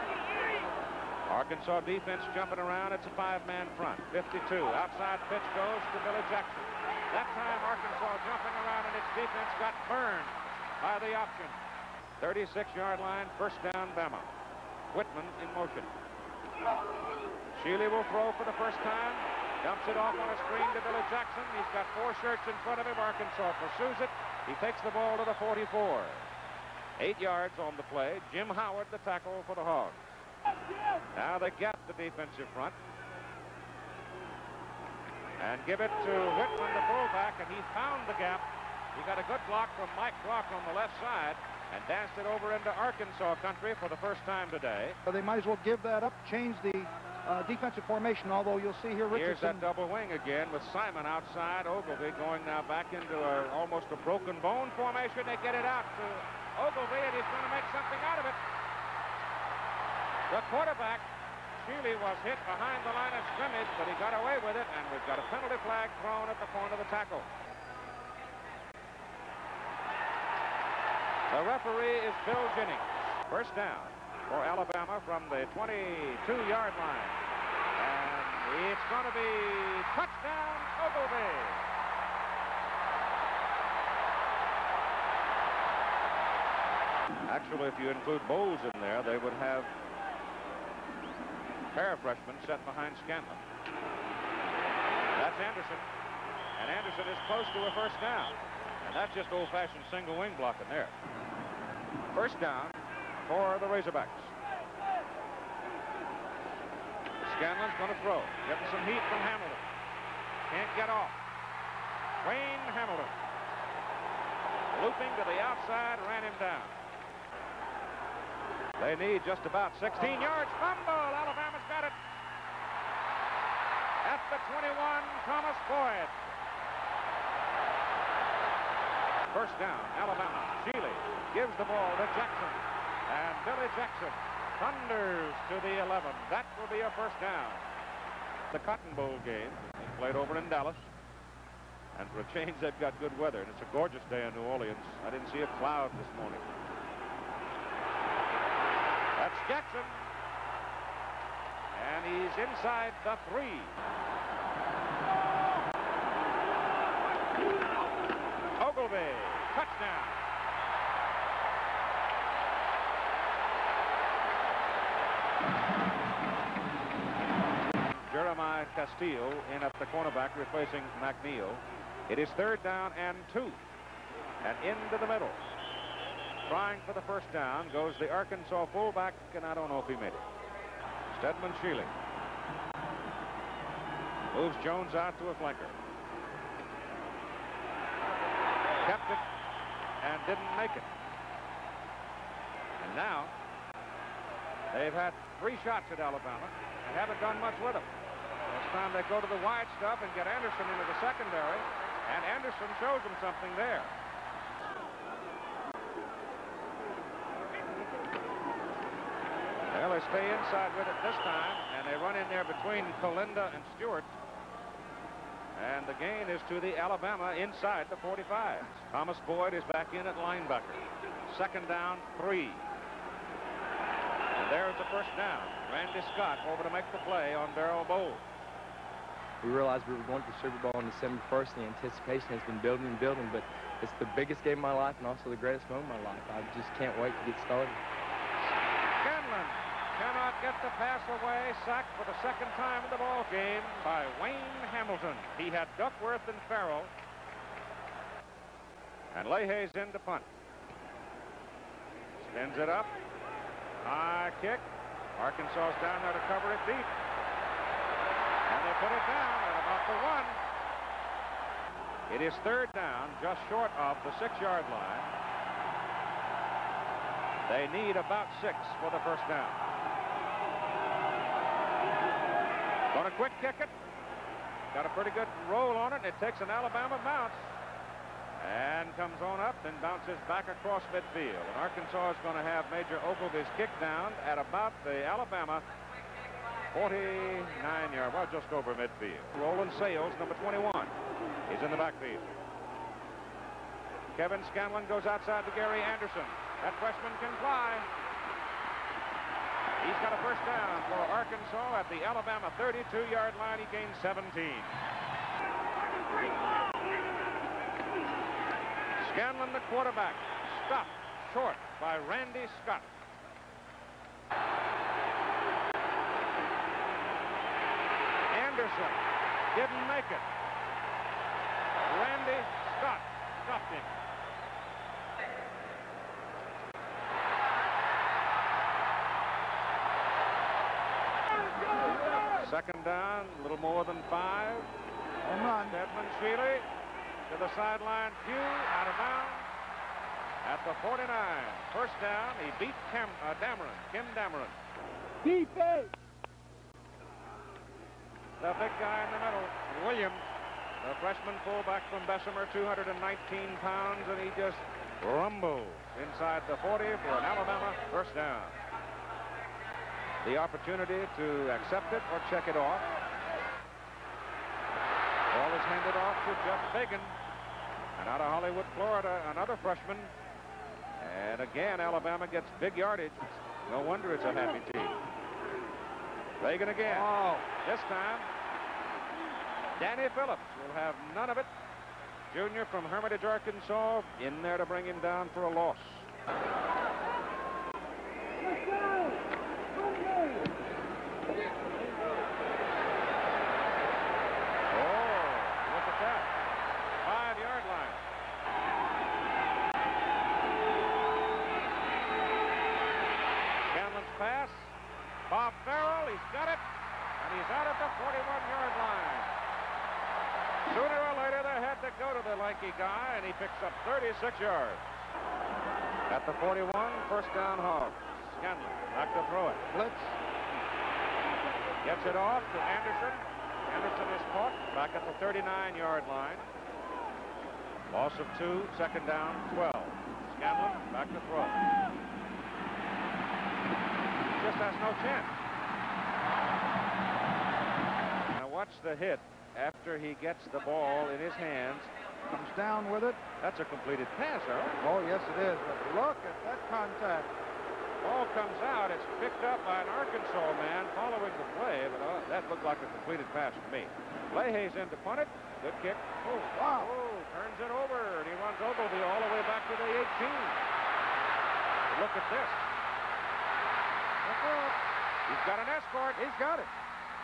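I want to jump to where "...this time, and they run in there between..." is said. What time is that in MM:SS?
03:31.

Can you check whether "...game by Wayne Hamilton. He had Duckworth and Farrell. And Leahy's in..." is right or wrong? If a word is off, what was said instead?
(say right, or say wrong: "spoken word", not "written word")
right.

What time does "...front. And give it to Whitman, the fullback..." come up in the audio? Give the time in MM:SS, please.
00:32.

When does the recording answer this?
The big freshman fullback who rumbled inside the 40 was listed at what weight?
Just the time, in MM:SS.
05:52.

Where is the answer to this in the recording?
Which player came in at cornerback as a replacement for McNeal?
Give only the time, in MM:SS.
02:48.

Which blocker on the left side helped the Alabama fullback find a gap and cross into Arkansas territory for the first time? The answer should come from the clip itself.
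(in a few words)
Mike Brock.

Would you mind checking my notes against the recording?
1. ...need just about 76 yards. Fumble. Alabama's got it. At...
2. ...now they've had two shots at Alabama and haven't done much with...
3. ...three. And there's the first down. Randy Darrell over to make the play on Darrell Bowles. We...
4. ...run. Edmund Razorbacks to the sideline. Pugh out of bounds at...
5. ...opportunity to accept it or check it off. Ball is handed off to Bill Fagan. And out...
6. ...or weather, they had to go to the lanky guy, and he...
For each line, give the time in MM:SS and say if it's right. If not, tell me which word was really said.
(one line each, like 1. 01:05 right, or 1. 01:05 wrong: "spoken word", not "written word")
1. 01:58 wrong: "16", not "76"
2. 03:12 wrong: "three", not "two"
3. 03:42 wrong: "Scott", not "Darrell"
4. 05:35 wrong: "Shealy", not "Razorbacks"
5. 06:00 wrong: "Jeff", not "Bill"
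6. 06:51 wrong: "later", not "weather".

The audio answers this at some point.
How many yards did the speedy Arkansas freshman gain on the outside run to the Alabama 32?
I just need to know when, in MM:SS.
05:04.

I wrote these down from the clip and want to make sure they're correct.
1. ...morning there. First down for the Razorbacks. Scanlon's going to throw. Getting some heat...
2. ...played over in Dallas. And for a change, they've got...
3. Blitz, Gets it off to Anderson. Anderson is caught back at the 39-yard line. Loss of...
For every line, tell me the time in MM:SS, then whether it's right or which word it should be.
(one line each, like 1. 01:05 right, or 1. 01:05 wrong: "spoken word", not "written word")
1. 01:40 wrong: "blocking", not "morning"
2. 02:19 right
3. 06:59 right.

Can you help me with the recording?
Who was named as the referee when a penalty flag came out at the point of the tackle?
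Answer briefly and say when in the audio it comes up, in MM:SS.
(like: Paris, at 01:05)
Bill Jennings, at 01:12.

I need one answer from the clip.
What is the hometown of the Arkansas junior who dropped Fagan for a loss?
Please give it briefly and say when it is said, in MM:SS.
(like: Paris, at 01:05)
Hermitage, Arkansas, at 06:22.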